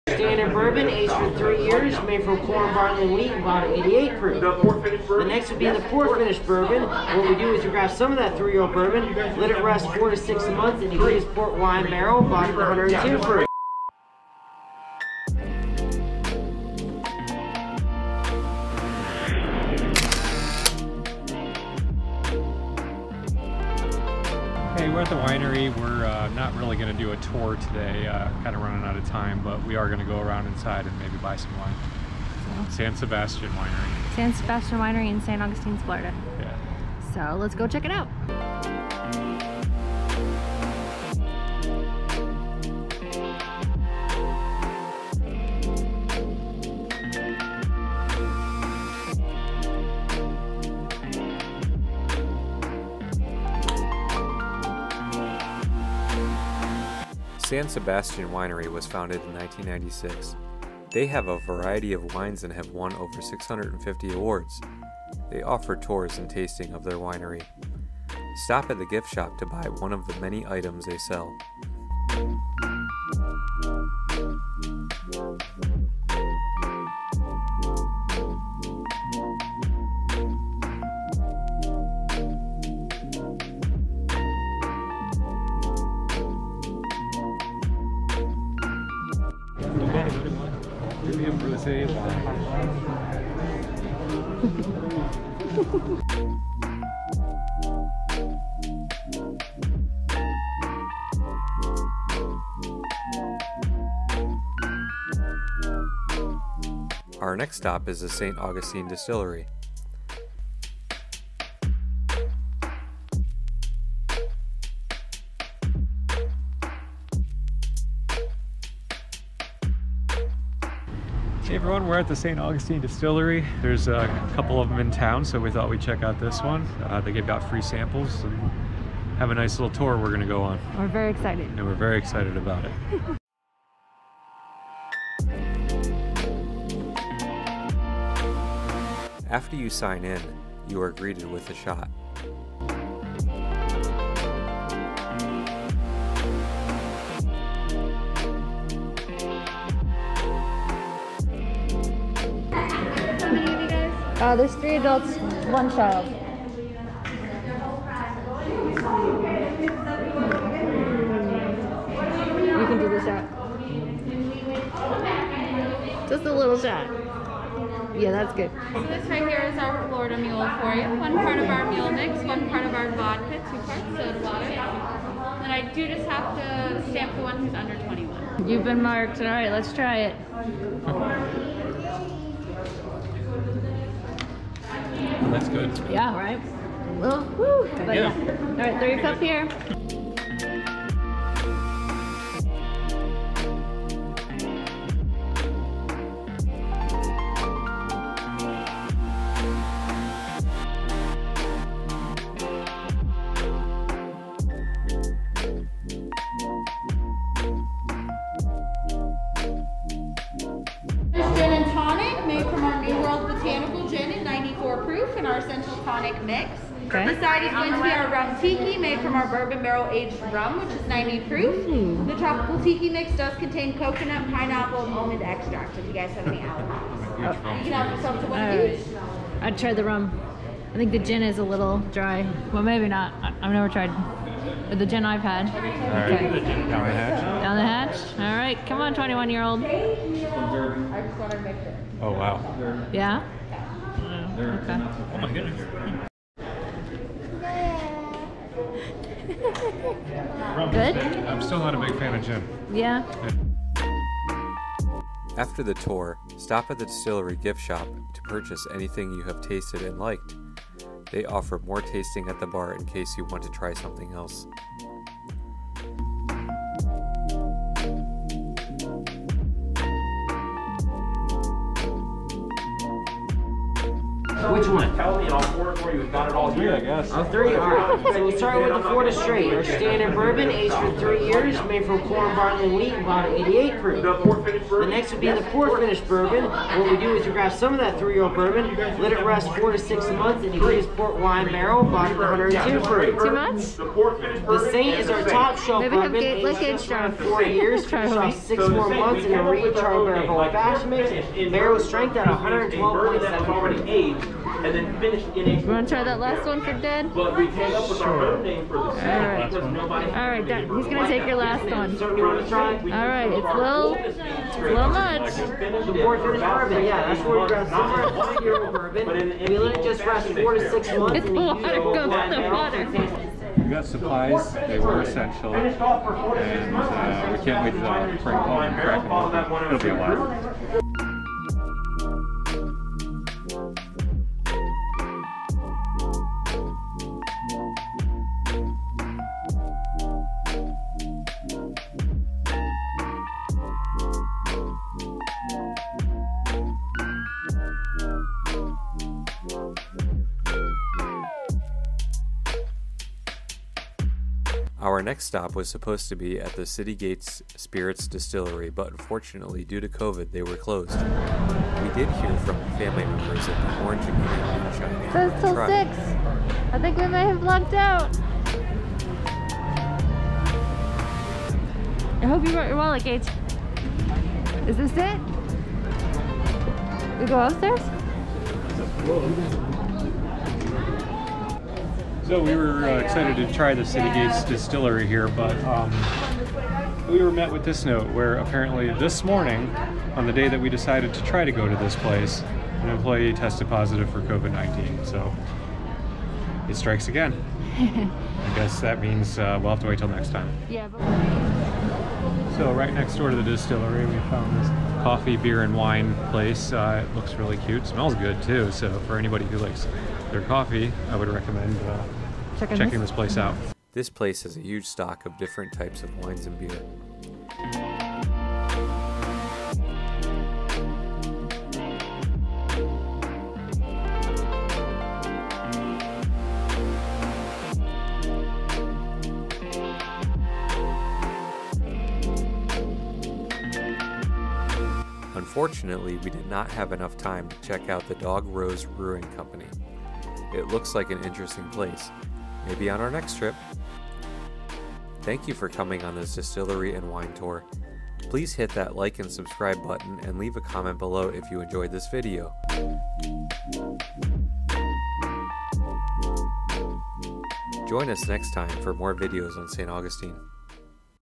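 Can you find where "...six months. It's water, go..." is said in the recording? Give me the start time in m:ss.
5:20.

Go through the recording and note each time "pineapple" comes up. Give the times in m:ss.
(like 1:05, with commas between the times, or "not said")
3:44.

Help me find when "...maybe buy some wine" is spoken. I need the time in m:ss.
0:30.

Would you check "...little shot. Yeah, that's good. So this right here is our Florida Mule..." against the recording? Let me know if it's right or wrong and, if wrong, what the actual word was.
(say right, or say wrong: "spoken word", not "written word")
right.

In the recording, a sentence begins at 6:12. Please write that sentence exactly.
I hope you brought your wallet, Gage.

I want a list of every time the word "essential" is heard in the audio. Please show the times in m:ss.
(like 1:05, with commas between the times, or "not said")
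5:25.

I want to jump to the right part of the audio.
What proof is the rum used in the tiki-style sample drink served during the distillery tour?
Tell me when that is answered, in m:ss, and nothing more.
3:40.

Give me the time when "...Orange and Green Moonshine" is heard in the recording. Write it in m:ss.
6:03.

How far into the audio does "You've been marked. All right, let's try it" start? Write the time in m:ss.
2:58.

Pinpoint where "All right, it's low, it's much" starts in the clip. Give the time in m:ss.
5:12.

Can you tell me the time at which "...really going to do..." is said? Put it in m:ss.
0:26.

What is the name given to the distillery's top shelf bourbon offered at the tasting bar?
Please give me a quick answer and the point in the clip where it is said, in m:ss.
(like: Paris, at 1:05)
The Saint, at 4:53.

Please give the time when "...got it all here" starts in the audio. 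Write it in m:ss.
4:36.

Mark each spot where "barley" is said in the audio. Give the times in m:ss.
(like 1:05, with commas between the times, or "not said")
0:02, 4:42.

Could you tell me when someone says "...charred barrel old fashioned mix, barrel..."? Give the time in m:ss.
4:59.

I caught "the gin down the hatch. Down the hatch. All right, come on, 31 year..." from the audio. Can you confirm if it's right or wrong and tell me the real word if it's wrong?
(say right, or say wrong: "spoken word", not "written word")
wrong: "21", not "31".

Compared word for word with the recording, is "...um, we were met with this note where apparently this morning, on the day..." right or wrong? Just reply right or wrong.
right.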